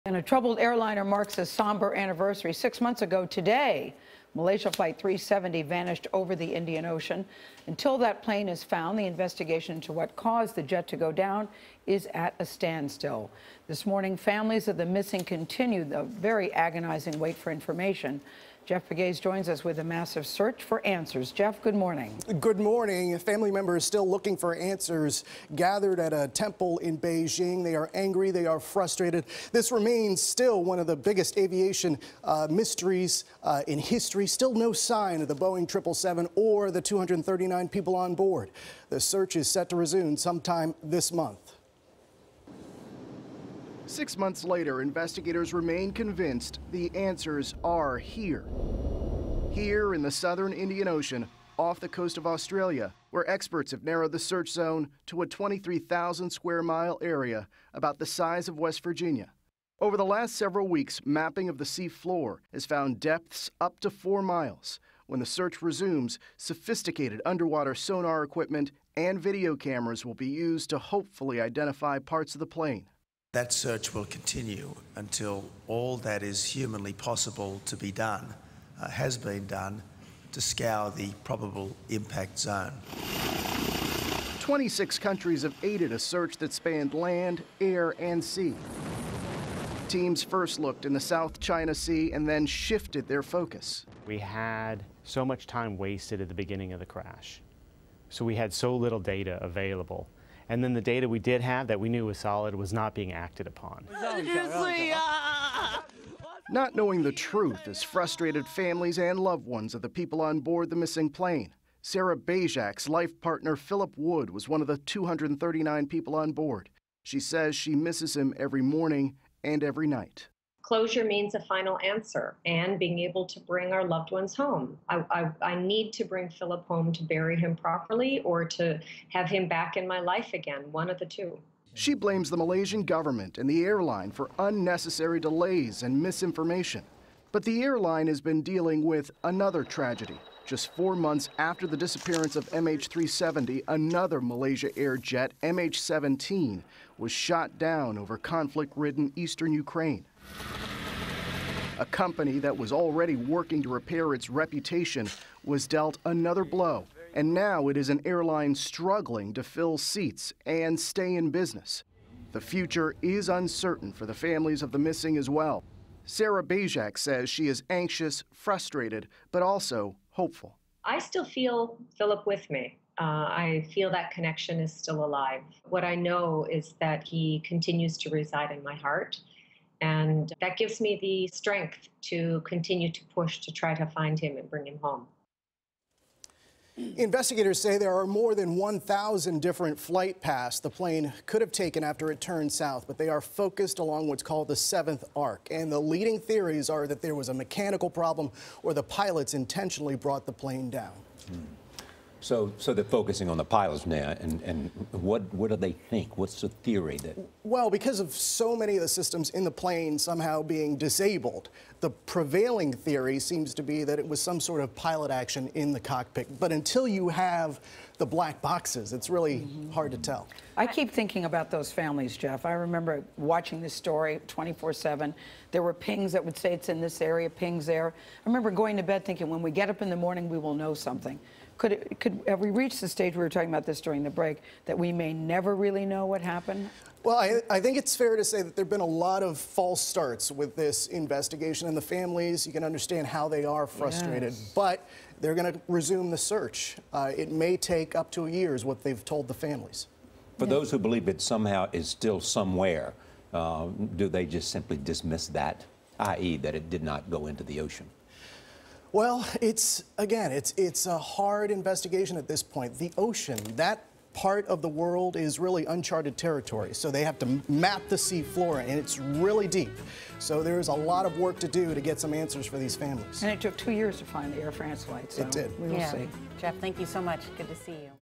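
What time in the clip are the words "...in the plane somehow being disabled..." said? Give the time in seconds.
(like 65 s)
209 s.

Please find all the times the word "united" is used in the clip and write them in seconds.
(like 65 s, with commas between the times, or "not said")
not said.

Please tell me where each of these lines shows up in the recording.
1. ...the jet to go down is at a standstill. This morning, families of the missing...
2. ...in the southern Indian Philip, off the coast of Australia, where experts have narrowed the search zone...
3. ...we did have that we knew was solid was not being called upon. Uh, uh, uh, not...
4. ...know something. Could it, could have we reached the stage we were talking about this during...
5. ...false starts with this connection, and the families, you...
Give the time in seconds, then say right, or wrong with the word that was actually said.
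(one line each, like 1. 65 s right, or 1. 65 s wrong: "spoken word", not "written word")
1. 10 s right
2. 49 s wrong: "Ocean", not "Philip"
3. 101 s wrong: "acted", not "called"
4. 230 s right
5. 239 s wrong: "investigation", not "connection".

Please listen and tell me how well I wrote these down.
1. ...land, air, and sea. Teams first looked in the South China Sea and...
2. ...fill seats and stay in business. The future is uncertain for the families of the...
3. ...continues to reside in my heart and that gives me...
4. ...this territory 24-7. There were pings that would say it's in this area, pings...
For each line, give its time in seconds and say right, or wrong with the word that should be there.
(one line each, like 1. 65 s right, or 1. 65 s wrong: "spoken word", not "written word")
1. 86 s right
2. 159 s right
3. 177 s right
4. 223 s wrong: "story", not "territory".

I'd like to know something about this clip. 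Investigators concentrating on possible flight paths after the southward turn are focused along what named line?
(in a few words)
the seventh arc.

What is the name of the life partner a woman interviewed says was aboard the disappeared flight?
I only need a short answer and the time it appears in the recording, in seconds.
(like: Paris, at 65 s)
Philip Wood, at 113 s.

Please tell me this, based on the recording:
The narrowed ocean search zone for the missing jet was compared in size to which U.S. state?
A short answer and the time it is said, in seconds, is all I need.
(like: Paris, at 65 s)
West Virginia, at 58 s.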